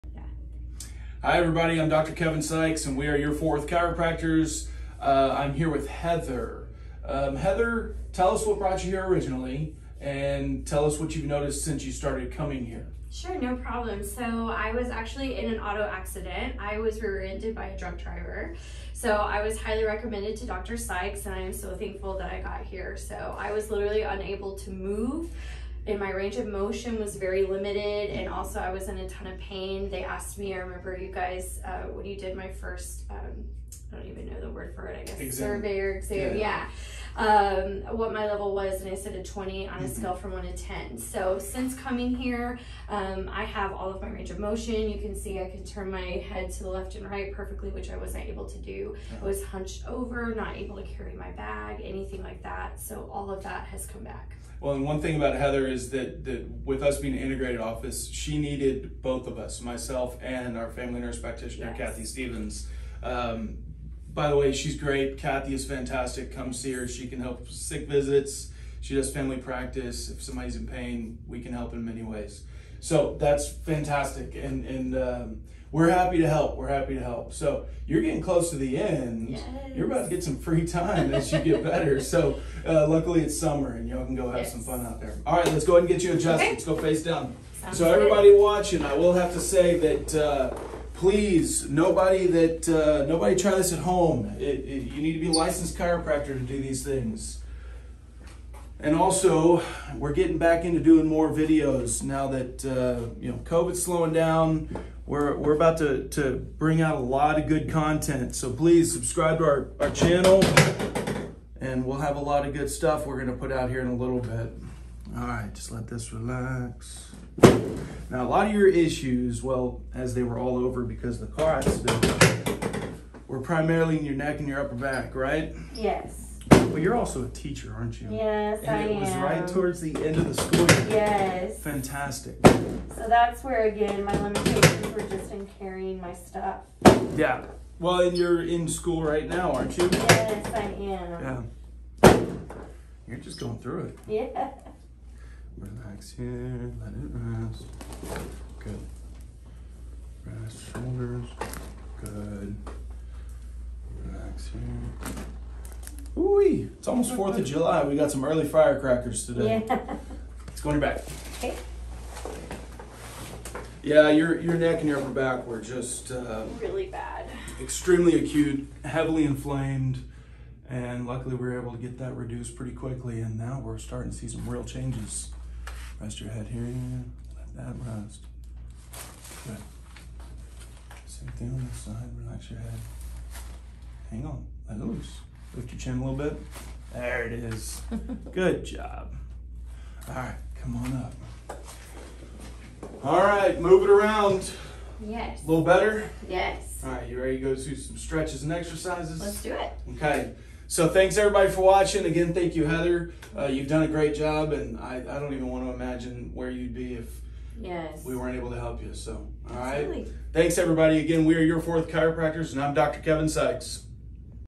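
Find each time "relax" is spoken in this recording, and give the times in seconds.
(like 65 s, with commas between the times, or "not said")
116 s, 145 s, 154 s, 182 s.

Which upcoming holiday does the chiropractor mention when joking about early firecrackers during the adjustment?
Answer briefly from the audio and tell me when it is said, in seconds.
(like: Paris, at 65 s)
4th of July, at 157 s.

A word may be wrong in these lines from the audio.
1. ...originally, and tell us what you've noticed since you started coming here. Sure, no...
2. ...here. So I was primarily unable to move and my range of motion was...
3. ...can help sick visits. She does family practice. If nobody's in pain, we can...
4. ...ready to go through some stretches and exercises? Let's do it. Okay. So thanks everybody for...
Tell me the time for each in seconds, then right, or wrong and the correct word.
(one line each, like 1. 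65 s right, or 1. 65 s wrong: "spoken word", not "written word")
1. 9 s right
2. 22 s wrong: "literally", not "primarily"
3. 67 s wrong: "somebody", not "nobody"
4. 197 s right.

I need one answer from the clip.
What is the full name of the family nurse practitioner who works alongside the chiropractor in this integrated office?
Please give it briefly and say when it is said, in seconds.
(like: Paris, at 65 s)
Kathy Stephens, at 61 s.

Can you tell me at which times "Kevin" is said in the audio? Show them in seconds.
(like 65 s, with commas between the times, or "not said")
2 s, 213 s.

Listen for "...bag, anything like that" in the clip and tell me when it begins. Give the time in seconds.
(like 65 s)
51 s.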